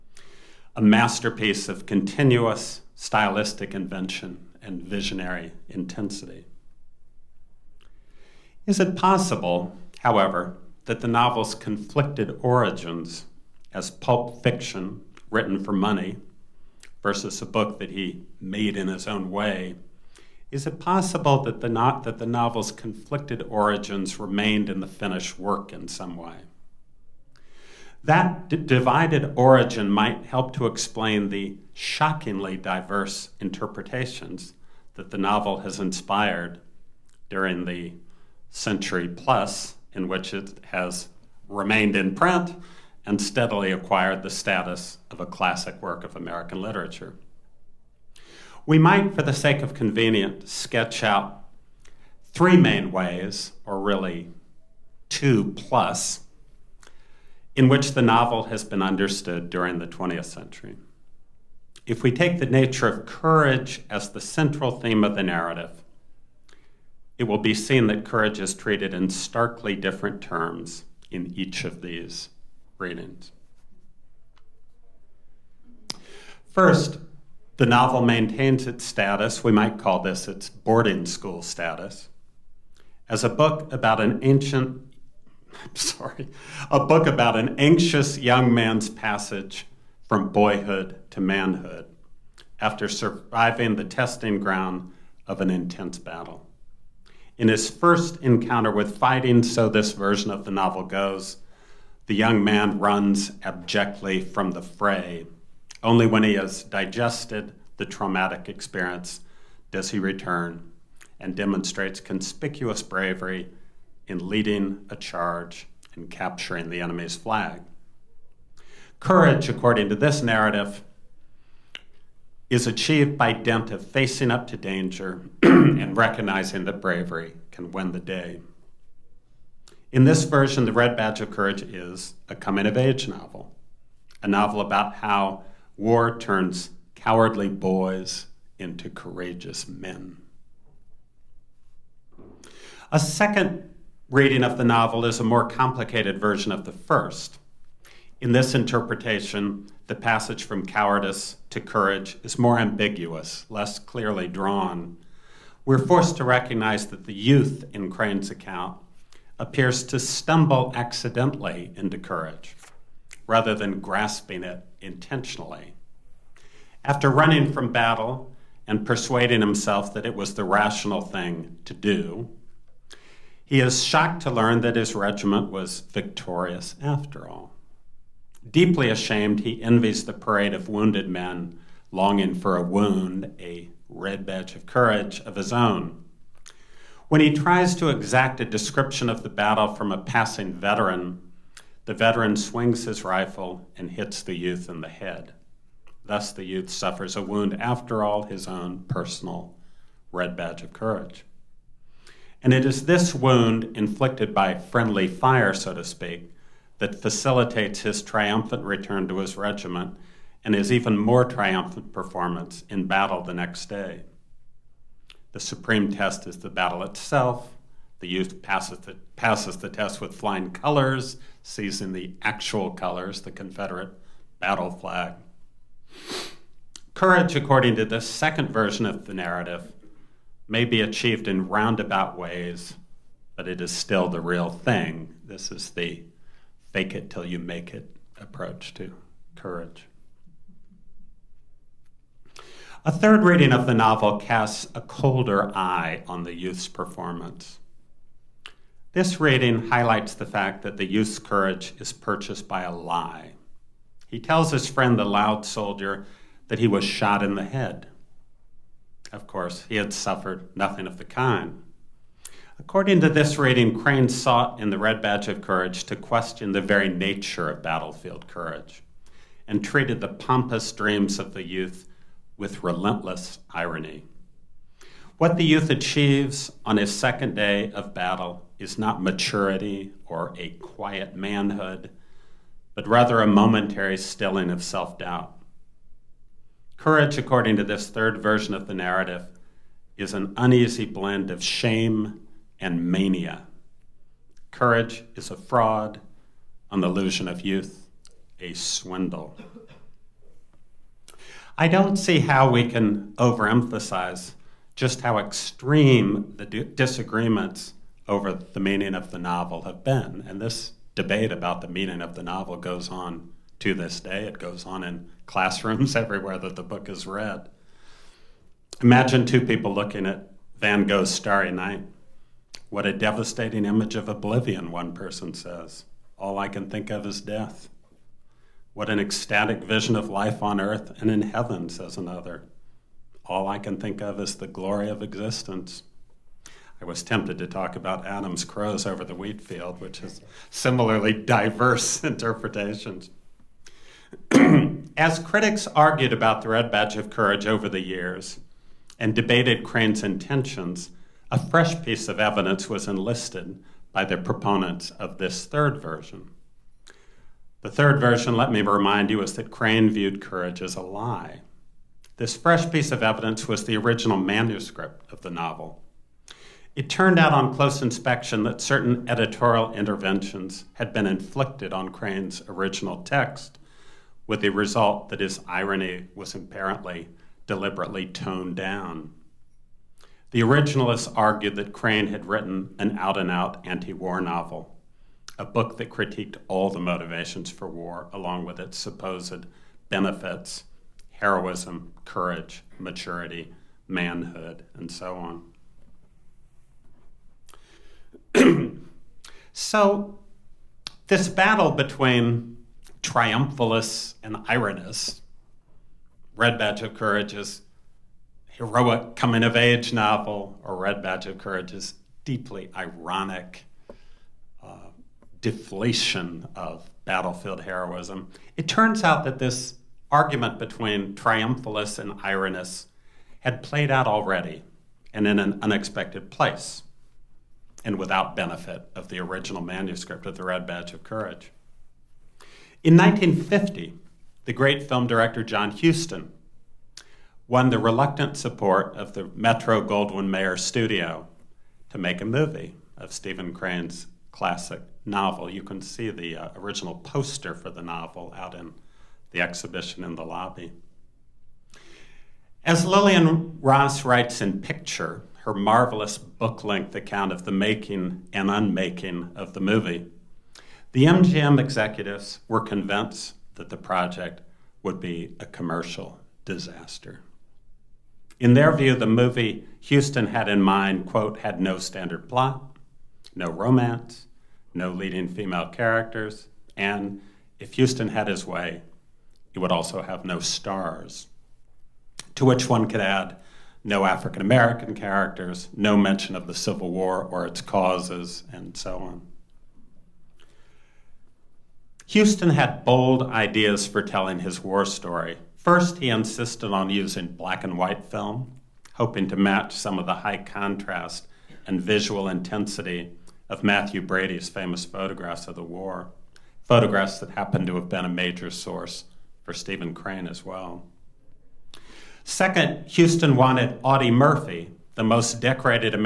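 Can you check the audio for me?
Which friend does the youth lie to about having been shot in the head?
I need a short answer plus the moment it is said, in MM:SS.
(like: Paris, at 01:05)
the loud soldier, at 04:14.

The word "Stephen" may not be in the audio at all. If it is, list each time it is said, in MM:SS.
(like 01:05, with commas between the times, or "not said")
07:23, 08:29.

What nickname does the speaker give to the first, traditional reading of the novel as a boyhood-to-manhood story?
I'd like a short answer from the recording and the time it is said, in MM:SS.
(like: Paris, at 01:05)
boarding school status, at 01:20.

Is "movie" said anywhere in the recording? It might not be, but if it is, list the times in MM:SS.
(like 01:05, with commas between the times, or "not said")
07:22, 07:39, 07:49.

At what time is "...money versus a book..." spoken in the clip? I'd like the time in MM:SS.
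00:15.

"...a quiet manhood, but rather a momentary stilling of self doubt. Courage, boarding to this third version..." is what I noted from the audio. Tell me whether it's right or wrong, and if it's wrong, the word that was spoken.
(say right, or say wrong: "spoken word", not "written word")
wrong: "according", not "boarding".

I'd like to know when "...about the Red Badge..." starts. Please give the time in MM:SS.
05:46.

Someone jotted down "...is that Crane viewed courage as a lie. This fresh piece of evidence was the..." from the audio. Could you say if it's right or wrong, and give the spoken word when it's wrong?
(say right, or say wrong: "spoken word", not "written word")
right.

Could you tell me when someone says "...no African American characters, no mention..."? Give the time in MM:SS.
08:03.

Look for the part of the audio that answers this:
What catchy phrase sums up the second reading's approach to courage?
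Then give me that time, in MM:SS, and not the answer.
03:56.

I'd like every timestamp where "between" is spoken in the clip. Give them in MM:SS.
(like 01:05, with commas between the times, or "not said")
06:41, 07:00.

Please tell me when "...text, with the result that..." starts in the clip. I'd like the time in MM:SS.
06:13.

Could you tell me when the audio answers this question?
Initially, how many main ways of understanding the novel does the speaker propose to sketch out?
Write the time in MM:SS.
00:52.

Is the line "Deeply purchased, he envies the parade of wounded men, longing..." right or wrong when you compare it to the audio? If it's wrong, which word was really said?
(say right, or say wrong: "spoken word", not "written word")
wrong: "ashamed", not "purchased".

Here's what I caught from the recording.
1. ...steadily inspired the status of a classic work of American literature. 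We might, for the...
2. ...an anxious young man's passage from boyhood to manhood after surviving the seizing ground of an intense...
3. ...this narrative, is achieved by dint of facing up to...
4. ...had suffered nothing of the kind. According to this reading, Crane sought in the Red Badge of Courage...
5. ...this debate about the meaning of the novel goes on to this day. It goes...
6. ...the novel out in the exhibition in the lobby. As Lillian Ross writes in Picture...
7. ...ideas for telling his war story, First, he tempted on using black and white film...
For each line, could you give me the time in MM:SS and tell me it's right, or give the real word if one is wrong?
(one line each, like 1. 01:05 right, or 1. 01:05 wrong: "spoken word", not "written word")
1. 00:43 wrong: "acquired", not "inspired"
2. 01:27 wrong: "testing", not "seizing"
3. 01:59 right
4. 04:19 right
5. 05:10 right
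6. 07:27 right
7. 08:13 wrong: "insisted", not "tempted".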